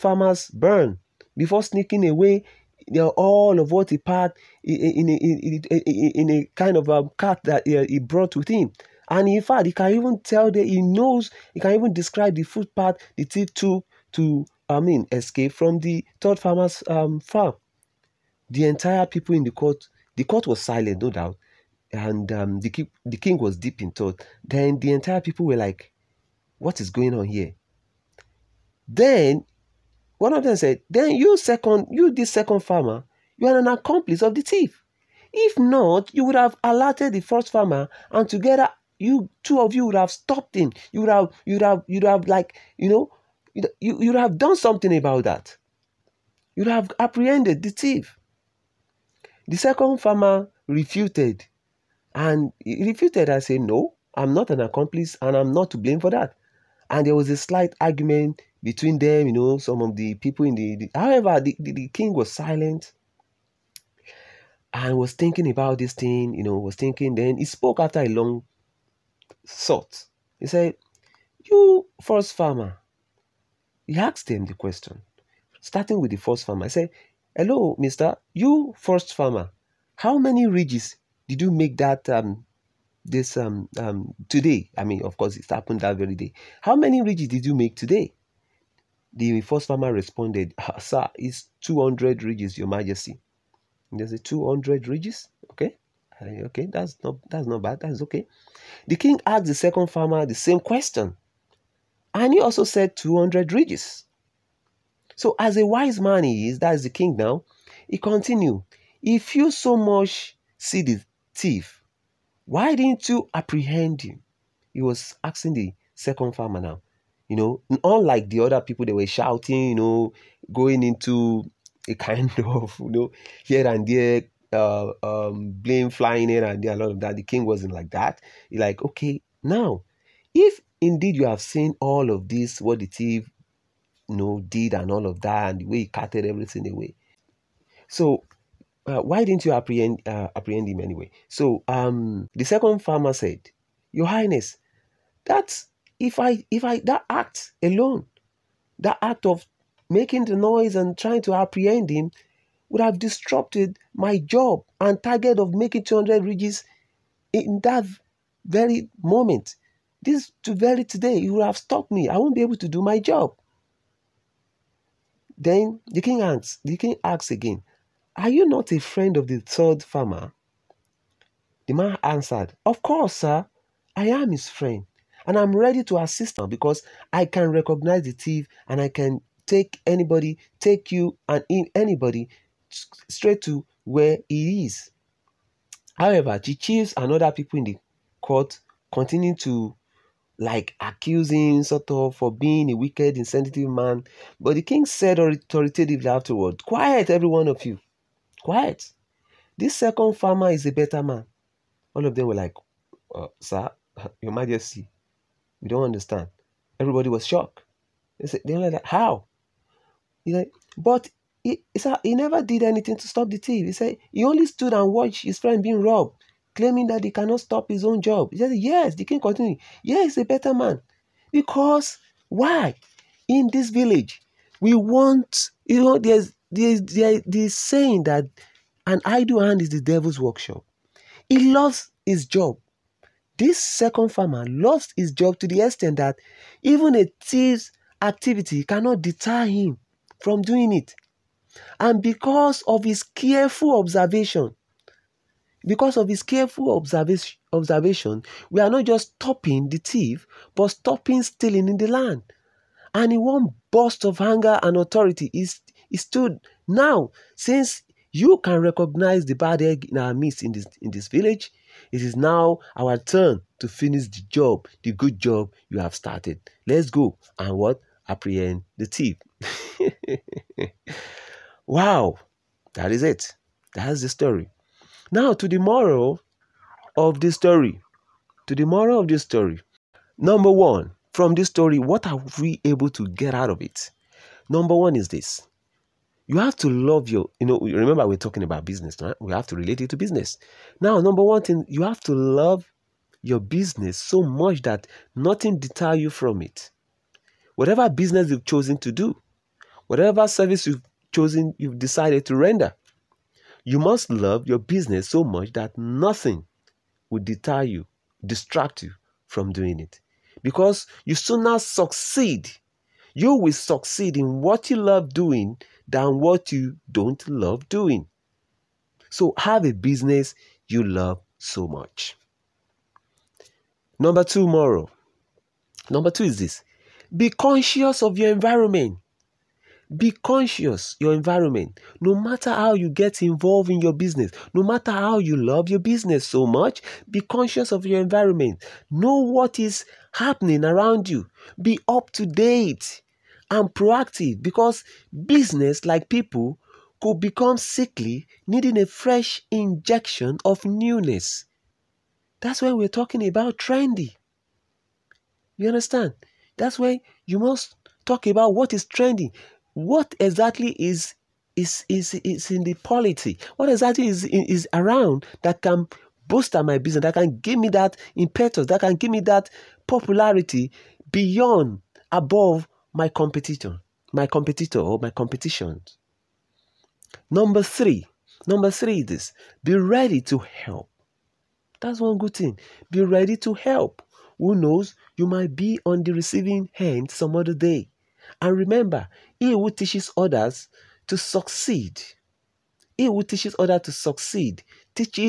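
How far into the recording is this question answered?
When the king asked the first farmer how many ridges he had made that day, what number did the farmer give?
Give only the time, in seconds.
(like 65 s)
91 s.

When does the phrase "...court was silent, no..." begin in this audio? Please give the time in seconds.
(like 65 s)
20 s.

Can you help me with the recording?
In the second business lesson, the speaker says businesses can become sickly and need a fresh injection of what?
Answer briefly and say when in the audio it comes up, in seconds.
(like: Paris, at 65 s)
newness, at 350 s.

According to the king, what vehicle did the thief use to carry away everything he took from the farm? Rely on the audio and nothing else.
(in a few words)
cart.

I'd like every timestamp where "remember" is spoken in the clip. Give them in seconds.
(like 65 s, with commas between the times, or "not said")
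287 s, 388 s.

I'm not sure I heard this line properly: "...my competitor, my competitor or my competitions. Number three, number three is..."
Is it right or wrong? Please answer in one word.
right.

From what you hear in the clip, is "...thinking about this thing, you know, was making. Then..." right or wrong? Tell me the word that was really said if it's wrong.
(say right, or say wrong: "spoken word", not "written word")
wrong: "thinking", not "making".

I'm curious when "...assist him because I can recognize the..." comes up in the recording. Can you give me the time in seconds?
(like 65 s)
175 s.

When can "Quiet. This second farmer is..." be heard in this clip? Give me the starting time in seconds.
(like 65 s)
198 s.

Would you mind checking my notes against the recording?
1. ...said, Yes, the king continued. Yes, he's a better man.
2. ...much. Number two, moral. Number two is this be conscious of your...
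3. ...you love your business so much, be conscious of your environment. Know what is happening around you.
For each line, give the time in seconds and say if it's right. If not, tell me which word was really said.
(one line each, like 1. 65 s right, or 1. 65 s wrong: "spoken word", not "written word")
1. 218 s right
2. 321 s right
3. 335 s right.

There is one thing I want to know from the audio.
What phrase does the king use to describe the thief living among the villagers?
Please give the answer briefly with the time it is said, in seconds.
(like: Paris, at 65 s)
bad egg, at 259 s.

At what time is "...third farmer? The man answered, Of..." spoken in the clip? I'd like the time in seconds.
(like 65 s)
169 s.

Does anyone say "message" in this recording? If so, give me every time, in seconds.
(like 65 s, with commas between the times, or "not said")
not said.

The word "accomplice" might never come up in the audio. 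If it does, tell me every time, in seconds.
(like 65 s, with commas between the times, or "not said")
33 s, 54 s.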